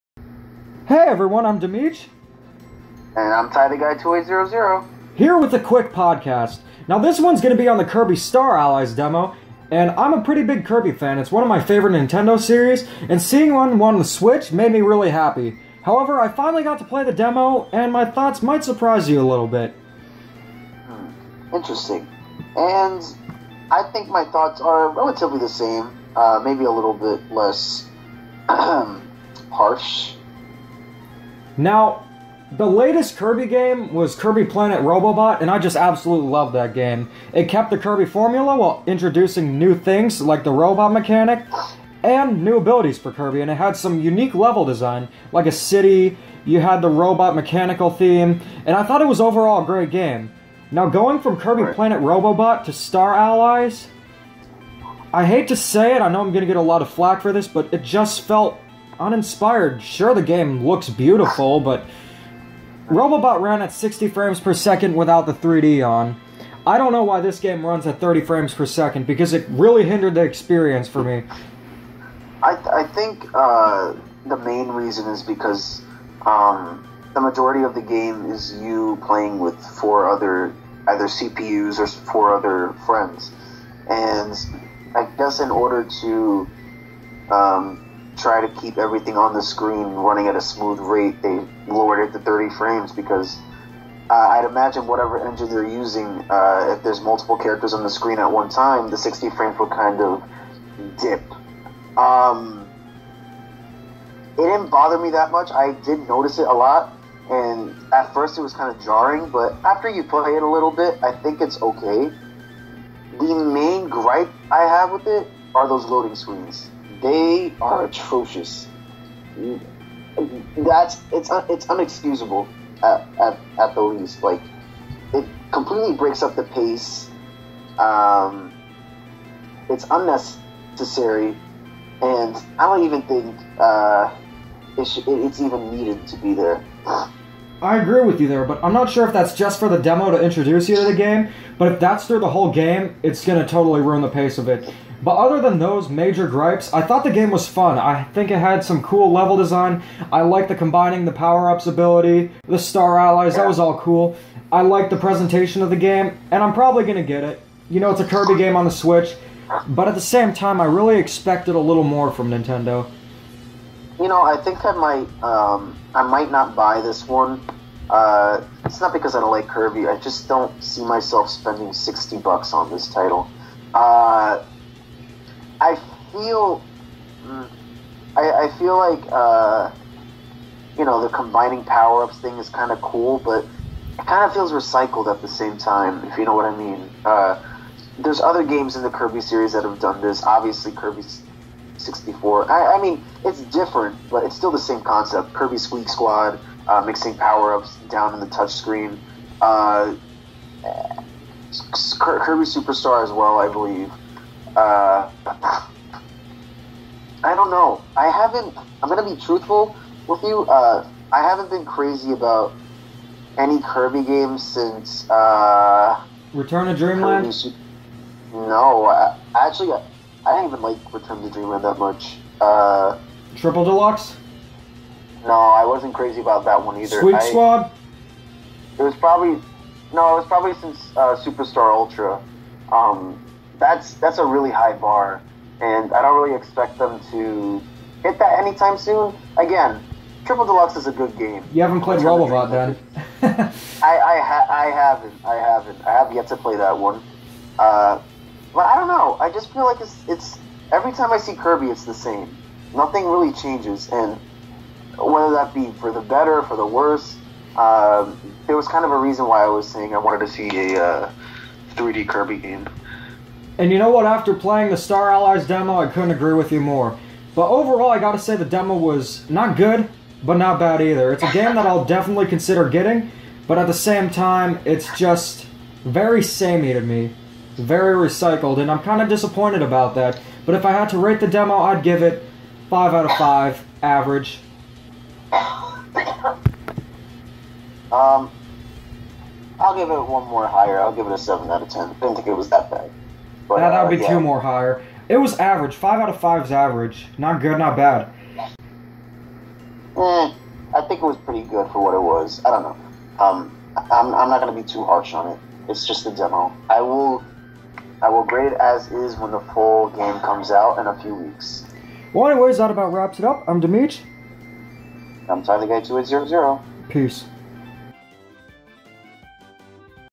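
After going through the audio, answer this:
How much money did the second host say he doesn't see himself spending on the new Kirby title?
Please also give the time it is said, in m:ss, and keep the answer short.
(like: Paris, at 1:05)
sixty bucks, at 2:51.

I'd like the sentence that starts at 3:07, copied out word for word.
Uh, there's other games in the Kirby series that have done this.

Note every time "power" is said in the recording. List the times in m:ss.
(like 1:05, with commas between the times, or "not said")
2:31, 3:01, 3:17.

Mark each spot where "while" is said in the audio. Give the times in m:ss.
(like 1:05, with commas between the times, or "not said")
0:38.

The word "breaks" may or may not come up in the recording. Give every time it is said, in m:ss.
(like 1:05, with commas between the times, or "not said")
2:05.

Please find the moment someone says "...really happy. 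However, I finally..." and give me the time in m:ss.
0:14.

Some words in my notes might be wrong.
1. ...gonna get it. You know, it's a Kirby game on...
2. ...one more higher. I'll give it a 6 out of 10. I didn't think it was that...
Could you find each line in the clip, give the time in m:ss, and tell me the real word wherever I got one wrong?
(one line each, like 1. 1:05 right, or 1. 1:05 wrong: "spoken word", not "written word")
1. 2:36 right
2. 4:50 wrong: "7", not "6".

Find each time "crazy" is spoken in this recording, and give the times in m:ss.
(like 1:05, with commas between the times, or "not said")
3:31, 3:45.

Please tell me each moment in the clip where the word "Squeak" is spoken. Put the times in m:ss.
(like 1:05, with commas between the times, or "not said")
3:15.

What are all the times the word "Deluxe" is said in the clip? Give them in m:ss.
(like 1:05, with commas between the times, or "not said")
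3:43, 4:00.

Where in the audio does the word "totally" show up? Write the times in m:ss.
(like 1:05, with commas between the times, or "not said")
2:23.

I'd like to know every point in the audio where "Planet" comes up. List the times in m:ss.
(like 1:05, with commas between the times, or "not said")
0:34, 0:51.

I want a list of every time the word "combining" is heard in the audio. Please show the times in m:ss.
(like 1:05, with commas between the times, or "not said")
2:30, 3:01.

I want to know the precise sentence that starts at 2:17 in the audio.
I agree with you there, but I'm not sure if that's just for the demo to introduce you to the game.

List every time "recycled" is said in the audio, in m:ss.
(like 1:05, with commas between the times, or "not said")
3:04, 4:37.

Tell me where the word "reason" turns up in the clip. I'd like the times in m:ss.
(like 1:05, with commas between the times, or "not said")
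1:14, 4:18.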